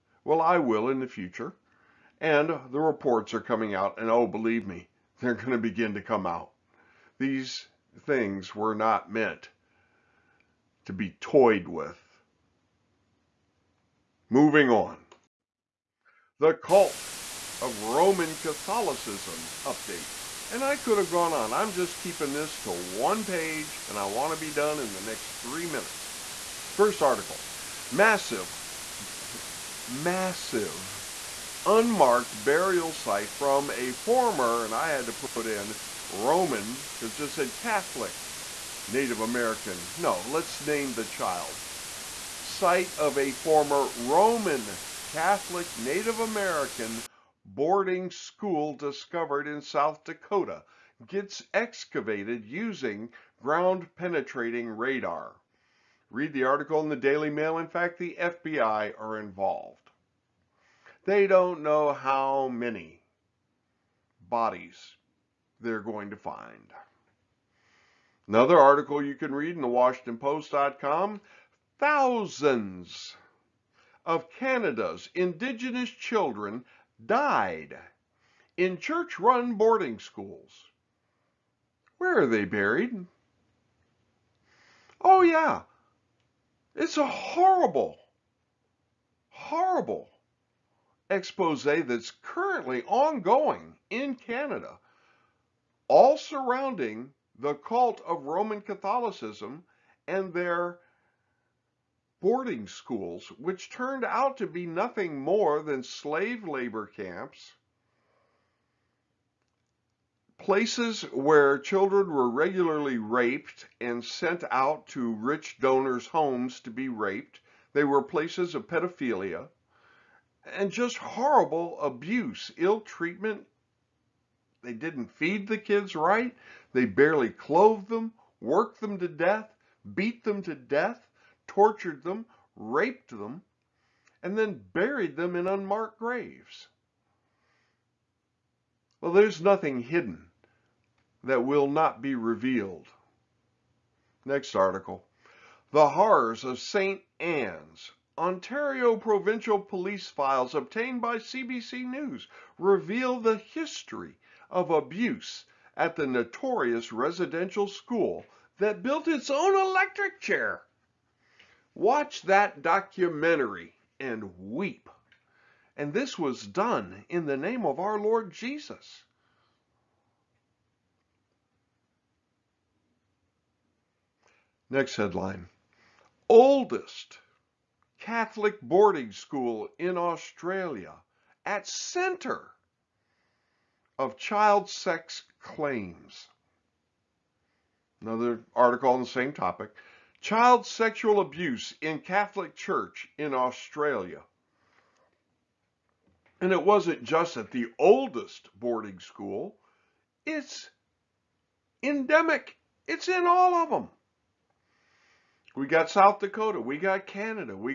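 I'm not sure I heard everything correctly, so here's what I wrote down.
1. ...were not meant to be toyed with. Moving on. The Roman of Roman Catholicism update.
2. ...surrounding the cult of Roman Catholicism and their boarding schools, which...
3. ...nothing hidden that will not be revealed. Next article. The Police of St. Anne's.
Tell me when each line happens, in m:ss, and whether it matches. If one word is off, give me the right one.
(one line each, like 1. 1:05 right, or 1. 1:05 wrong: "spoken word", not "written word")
1. 0:08 wrong: "Cult", not "Roman"
2. 1:36 right
3. 2:19 wrong: "Horrors", not "Police".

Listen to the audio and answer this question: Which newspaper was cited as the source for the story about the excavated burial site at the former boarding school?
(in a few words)
Daily Mail.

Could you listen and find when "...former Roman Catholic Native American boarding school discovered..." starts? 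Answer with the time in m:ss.
0:43.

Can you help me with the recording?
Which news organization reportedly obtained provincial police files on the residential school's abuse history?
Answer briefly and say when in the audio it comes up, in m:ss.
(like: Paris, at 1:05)
CBC News, at 2:31.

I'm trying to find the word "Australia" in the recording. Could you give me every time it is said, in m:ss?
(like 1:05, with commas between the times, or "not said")
2:59, 3:13.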